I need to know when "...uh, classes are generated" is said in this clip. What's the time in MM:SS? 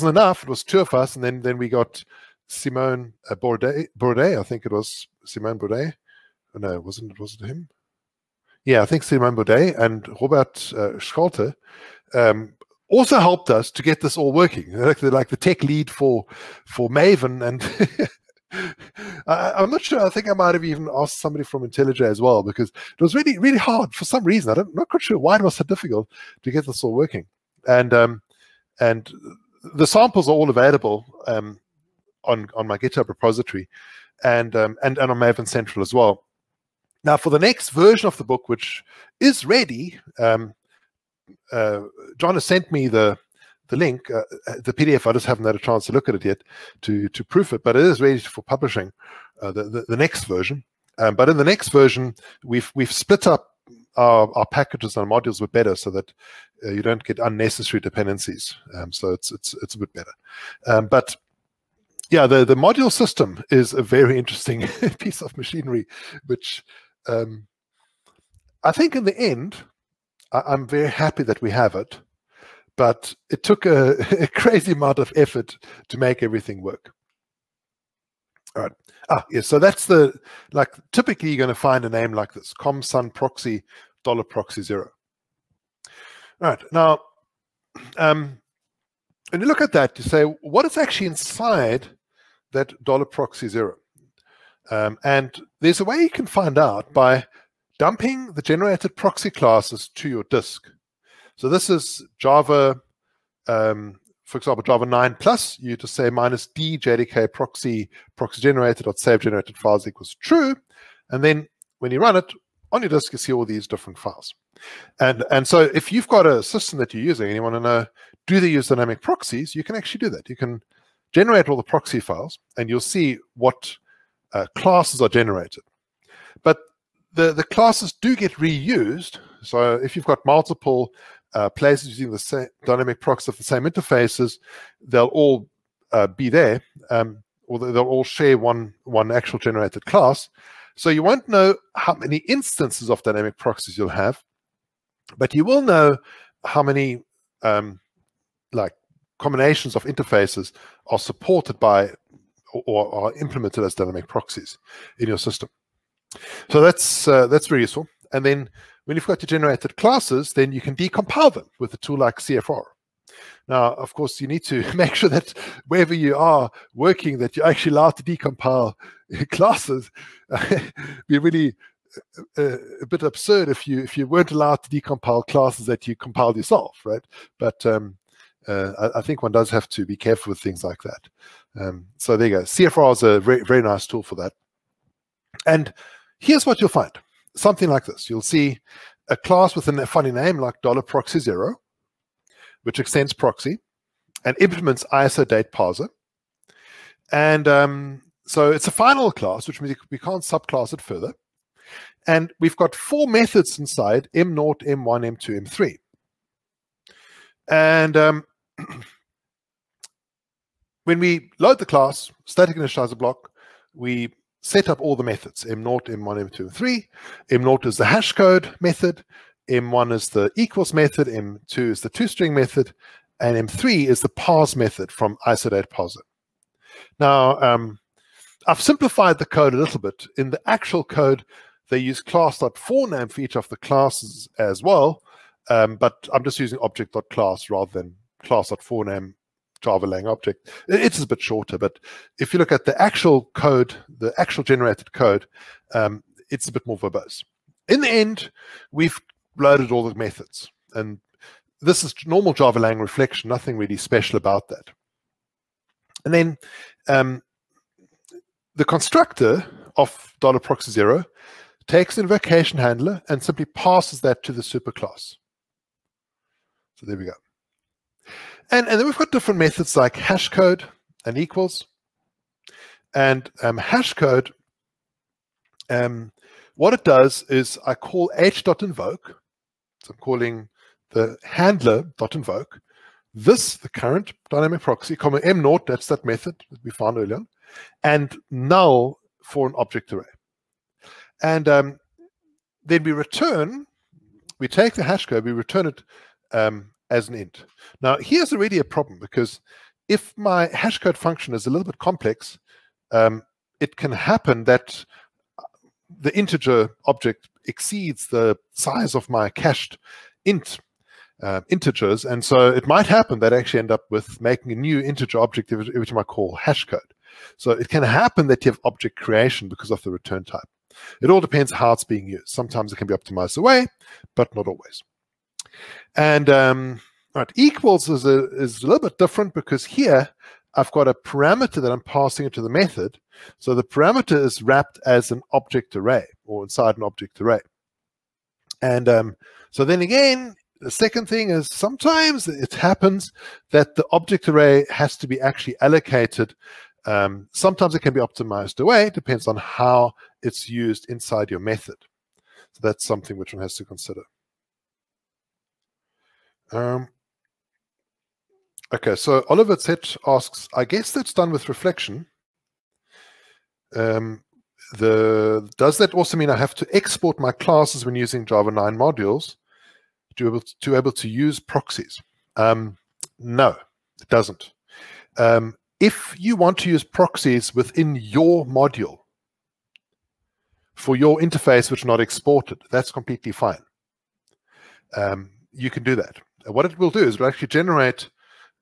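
02:04.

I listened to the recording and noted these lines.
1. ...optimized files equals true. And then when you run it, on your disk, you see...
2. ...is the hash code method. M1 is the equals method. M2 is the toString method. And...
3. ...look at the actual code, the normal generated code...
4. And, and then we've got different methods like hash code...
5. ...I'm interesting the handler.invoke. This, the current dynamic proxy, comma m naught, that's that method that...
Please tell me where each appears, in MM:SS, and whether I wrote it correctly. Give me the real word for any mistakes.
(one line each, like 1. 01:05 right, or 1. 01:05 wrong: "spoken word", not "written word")
1. 01:49 wrong: "generated", not "optimized"
2. 03:37 right
3. 04:02 wrong: "actual", not "normal"
4. 04:28 right
5. 04:39 wrong: "calling", not "interesting".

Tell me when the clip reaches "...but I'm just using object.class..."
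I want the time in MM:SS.
03:55.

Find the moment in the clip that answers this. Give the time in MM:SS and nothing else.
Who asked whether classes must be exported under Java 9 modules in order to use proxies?
05:59.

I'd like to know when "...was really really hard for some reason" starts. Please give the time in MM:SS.
00:23.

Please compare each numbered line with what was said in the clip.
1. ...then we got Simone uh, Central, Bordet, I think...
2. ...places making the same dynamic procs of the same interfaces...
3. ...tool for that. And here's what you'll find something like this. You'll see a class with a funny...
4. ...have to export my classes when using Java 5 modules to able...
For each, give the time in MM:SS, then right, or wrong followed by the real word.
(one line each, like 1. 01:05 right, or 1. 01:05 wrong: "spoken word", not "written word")
1. 00:01 wrong: "Bordet", not "Central"
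2. 02:11 wrong: "using", not "making"
3. 03:03 right
4. 06:06 wrong: "9", not "5".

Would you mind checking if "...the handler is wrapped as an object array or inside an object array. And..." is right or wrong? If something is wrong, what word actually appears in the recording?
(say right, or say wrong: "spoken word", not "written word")
wrong: "parameter", not "handler".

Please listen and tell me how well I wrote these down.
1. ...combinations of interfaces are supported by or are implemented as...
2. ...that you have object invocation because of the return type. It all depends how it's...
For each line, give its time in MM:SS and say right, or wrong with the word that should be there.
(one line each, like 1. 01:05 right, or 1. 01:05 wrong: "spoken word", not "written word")
1. 02:29 right
2. 05:18 wrong: "creation", not "invocation".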